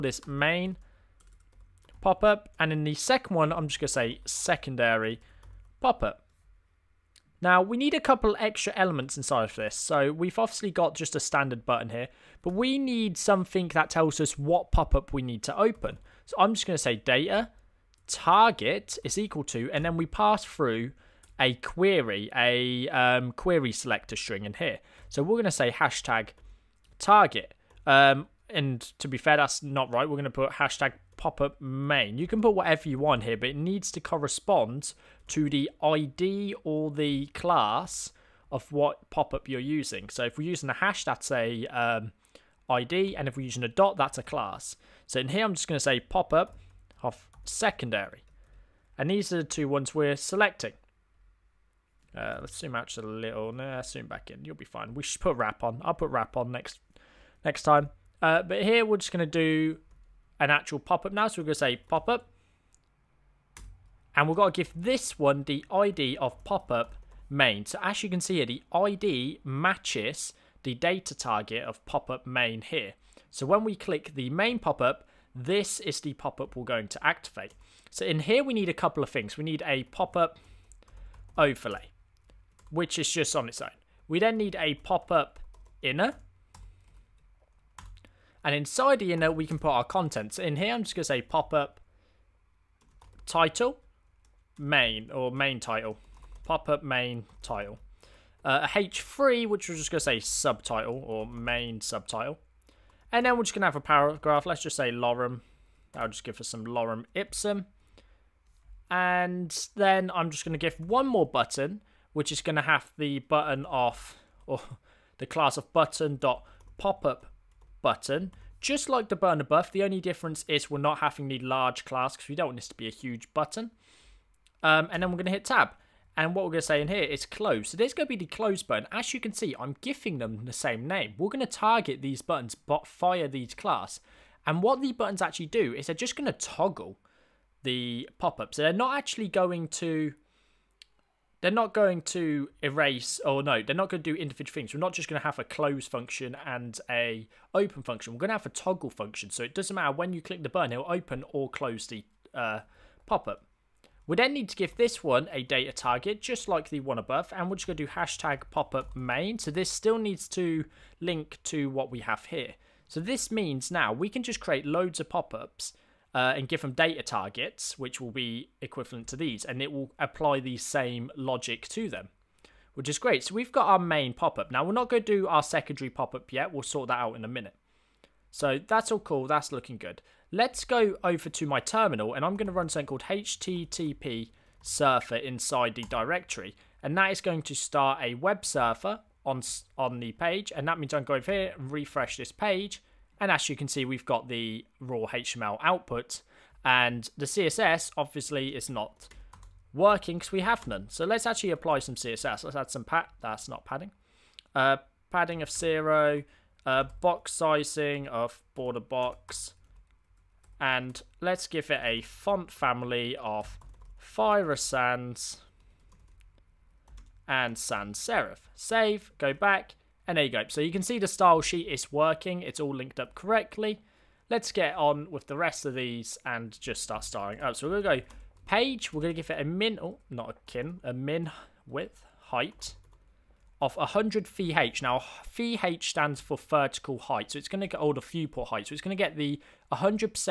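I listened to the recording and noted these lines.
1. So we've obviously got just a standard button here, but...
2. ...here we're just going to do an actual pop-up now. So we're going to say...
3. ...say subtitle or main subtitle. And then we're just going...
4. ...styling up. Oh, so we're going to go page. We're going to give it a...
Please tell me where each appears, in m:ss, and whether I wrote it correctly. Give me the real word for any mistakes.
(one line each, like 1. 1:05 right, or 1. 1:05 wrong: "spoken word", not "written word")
1. 0:09 right
2. 0:58 right
3. 1:40 right
4. 3:47 right.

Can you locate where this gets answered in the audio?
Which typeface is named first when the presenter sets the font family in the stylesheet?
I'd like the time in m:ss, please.
3:34.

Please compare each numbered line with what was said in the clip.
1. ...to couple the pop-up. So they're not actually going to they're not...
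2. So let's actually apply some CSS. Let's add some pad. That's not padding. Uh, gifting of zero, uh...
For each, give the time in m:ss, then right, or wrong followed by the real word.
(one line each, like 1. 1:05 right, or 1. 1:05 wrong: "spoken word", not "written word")
1. 2:16 wrong: "toggle", not "couple"
2. 3:20 wrong: "padding", not "gifting".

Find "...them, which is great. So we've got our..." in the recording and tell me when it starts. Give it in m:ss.
2:51.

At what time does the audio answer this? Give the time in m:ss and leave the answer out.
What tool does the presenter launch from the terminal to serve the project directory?
3:03.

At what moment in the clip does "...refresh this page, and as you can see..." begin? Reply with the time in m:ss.
3:11.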